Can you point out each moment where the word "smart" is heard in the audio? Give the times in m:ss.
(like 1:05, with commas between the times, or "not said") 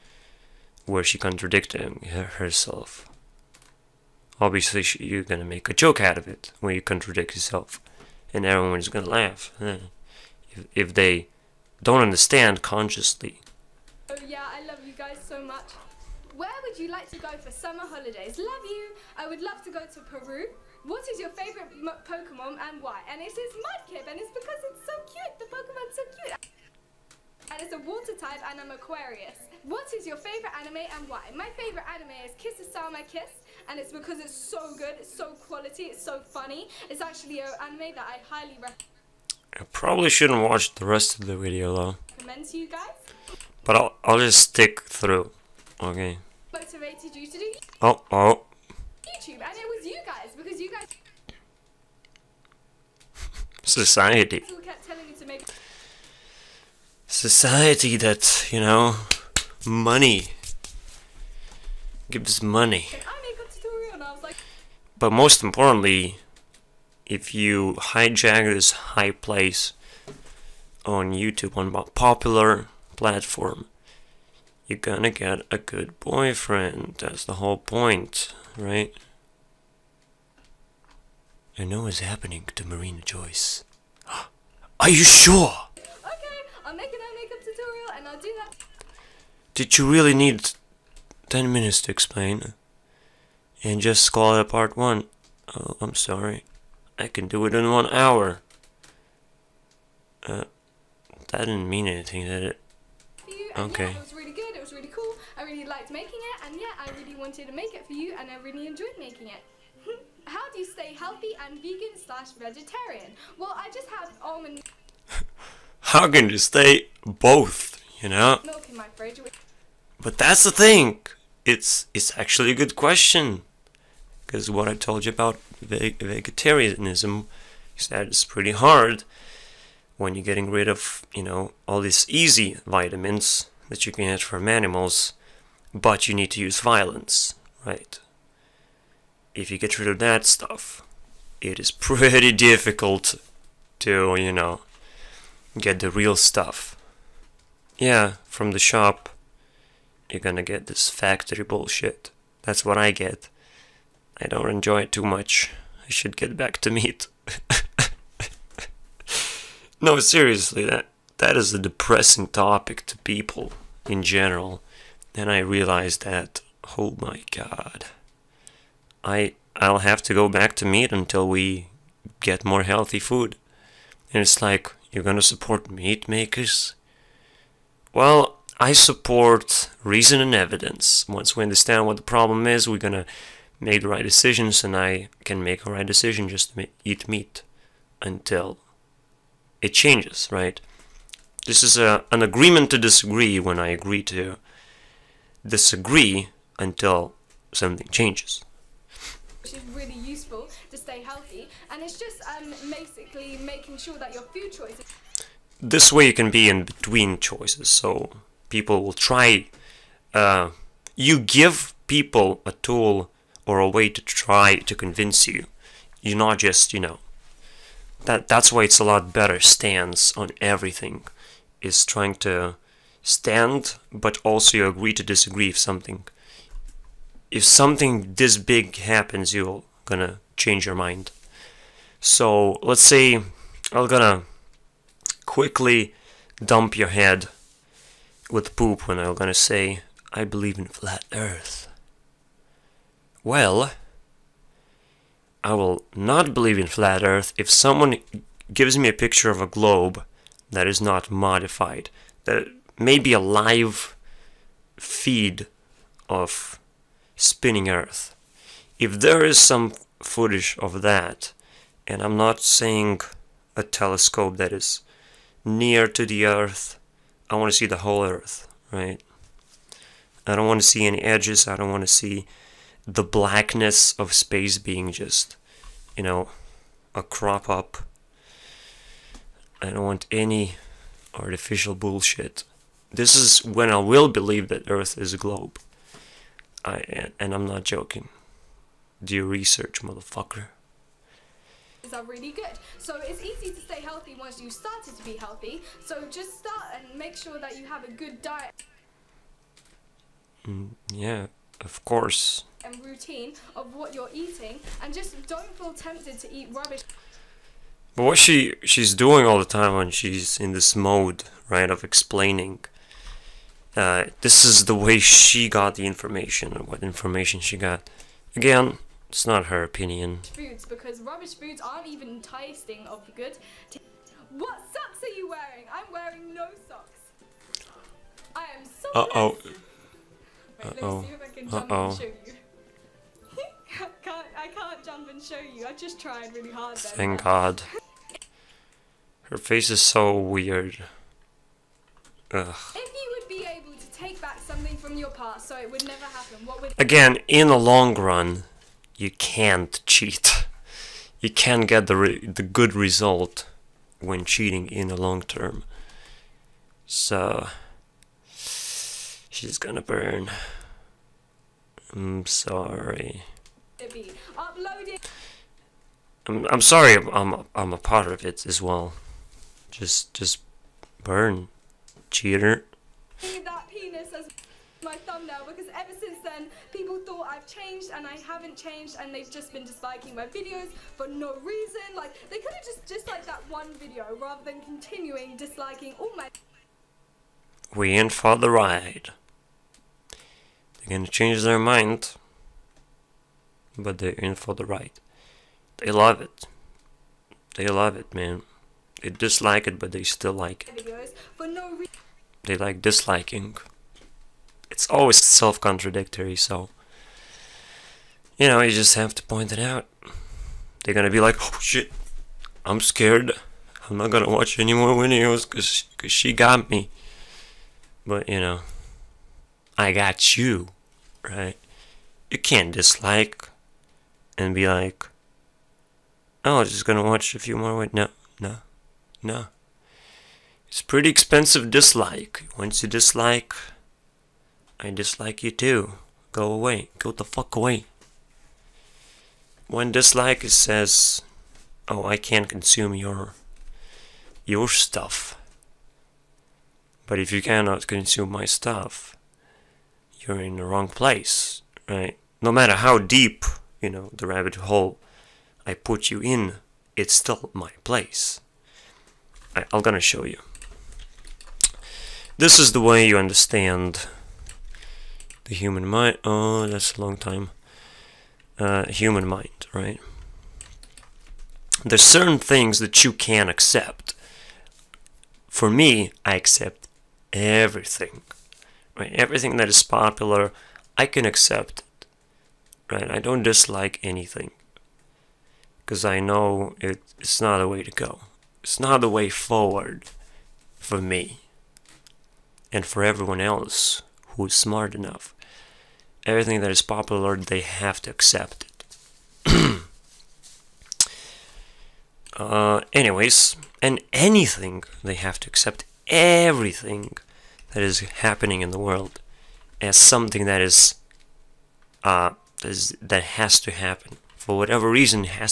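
8:14.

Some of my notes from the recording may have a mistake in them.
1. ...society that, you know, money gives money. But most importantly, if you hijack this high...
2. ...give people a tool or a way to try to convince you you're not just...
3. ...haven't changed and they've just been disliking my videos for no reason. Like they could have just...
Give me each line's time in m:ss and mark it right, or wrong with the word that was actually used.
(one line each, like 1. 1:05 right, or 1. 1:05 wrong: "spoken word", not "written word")
1. 0:57 right
2. 3:31 right
3. 6:18 right.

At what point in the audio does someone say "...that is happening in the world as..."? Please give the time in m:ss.
8:27.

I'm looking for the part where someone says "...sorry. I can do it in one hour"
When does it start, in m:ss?
1:35.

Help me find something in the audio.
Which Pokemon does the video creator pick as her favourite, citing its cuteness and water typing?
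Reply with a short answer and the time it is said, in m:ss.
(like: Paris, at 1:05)
Mudkip, at 0:23.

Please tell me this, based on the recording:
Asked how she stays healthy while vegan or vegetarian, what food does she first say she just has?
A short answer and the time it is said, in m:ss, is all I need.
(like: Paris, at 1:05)
almond, at 1:54.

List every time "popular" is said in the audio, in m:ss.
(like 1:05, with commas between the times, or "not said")
1:11, 7:59, 8:16.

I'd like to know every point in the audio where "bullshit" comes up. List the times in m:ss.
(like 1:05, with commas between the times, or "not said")
2:31, 4:41.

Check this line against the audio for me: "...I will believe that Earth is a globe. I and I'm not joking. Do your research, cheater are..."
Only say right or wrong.
wrong.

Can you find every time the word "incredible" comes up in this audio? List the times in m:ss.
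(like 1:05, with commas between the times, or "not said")
not said.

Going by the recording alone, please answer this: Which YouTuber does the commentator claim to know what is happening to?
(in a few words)
Marina Joyce.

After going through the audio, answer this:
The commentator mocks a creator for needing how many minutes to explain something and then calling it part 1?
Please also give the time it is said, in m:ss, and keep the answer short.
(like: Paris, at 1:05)
10, at 1:31.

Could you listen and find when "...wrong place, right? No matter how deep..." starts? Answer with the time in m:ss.
7:30.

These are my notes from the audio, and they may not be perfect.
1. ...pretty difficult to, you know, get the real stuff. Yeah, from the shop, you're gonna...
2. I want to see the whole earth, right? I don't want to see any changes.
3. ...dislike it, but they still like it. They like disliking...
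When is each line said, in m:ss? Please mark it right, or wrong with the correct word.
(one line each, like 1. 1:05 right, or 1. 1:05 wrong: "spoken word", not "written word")
1. 2:21 right
2. 4:27 wrong: "edges", not "changes"
3. 6:39 right.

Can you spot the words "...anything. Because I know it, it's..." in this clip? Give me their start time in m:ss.
8:04.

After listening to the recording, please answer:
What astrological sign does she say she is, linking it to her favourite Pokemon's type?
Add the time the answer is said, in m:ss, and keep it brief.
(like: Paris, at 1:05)
Aquarius, at 0:28.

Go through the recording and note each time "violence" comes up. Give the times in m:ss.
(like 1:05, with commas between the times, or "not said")
2:16.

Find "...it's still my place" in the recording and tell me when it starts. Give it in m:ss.
7:36.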